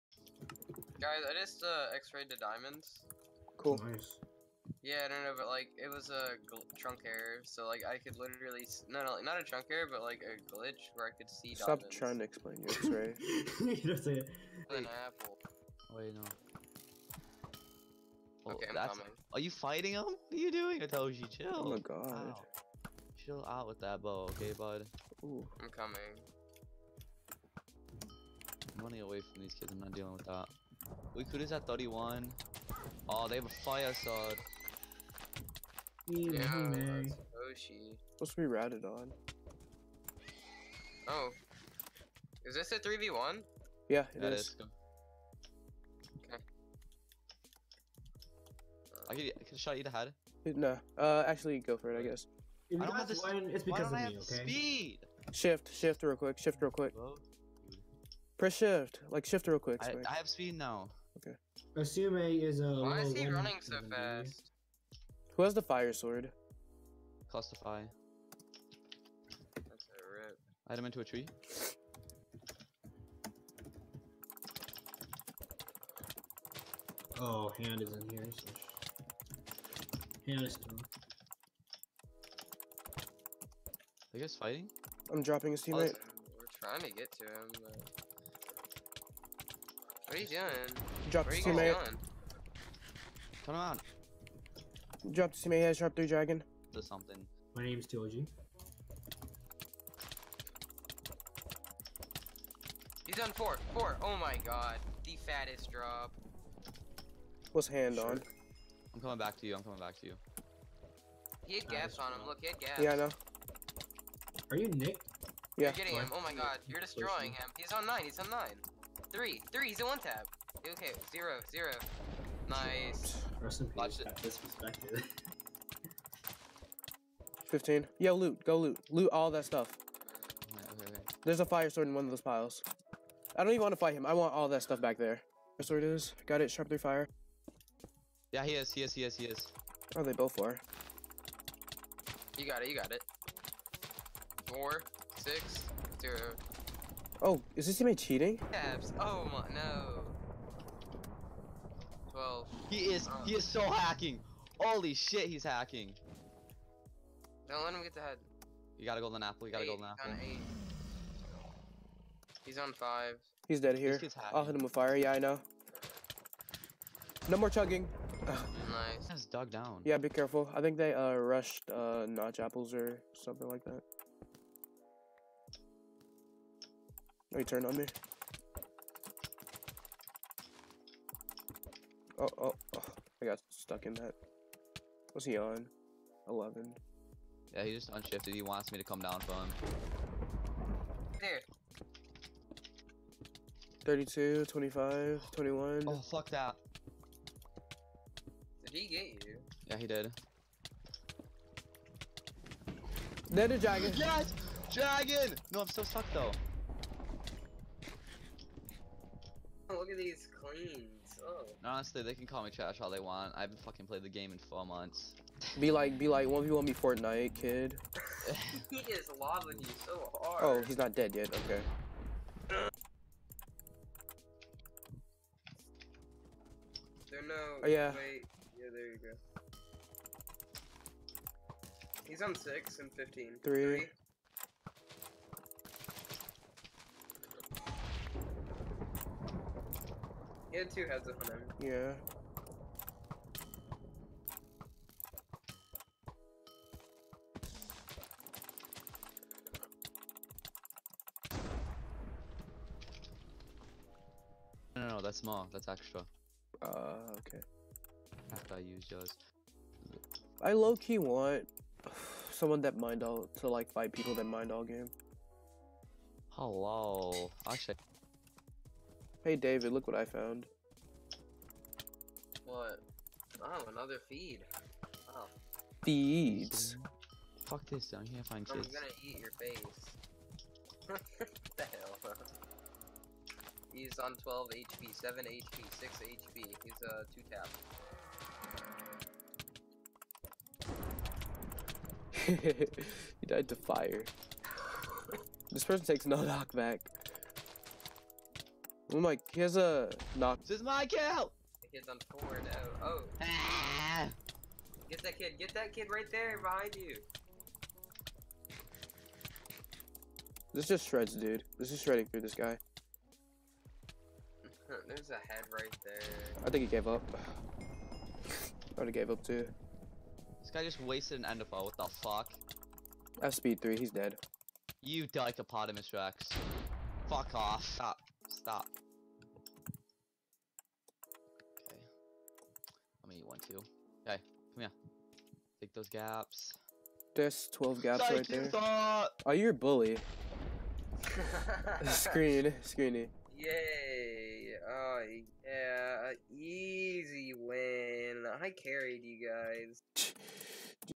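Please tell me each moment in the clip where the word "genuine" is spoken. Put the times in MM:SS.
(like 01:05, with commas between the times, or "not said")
not said.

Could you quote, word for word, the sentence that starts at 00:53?
One, it's because of me, okay?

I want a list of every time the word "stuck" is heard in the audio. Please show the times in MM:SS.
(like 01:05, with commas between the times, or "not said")
03:03, 03:25.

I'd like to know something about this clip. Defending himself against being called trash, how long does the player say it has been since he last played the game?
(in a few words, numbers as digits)
4 months.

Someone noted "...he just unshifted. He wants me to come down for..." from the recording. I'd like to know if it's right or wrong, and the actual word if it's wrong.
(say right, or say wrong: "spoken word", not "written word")
right.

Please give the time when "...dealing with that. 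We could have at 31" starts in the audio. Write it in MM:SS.
00:29.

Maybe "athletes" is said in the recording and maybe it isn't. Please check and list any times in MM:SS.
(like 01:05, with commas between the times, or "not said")
not said.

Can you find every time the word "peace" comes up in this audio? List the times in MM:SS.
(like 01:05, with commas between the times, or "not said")
02:03.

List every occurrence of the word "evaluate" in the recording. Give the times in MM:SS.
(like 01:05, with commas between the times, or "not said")
not said.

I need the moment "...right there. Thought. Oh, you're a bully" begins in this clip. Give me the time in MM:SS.
05:38.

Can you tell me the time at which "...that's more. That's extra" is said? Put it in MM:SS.
04:15.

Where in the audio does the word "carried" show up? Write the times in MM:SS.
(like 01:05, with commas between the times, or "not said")
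05:48.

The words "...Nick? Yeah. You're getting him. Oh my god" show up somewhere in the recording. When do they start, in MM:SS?
01:54.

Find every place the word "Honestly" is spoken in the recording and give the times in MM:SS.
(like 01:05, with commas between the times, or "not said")
03:31.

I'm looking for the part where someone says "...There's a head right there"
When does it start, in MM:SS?
05:14.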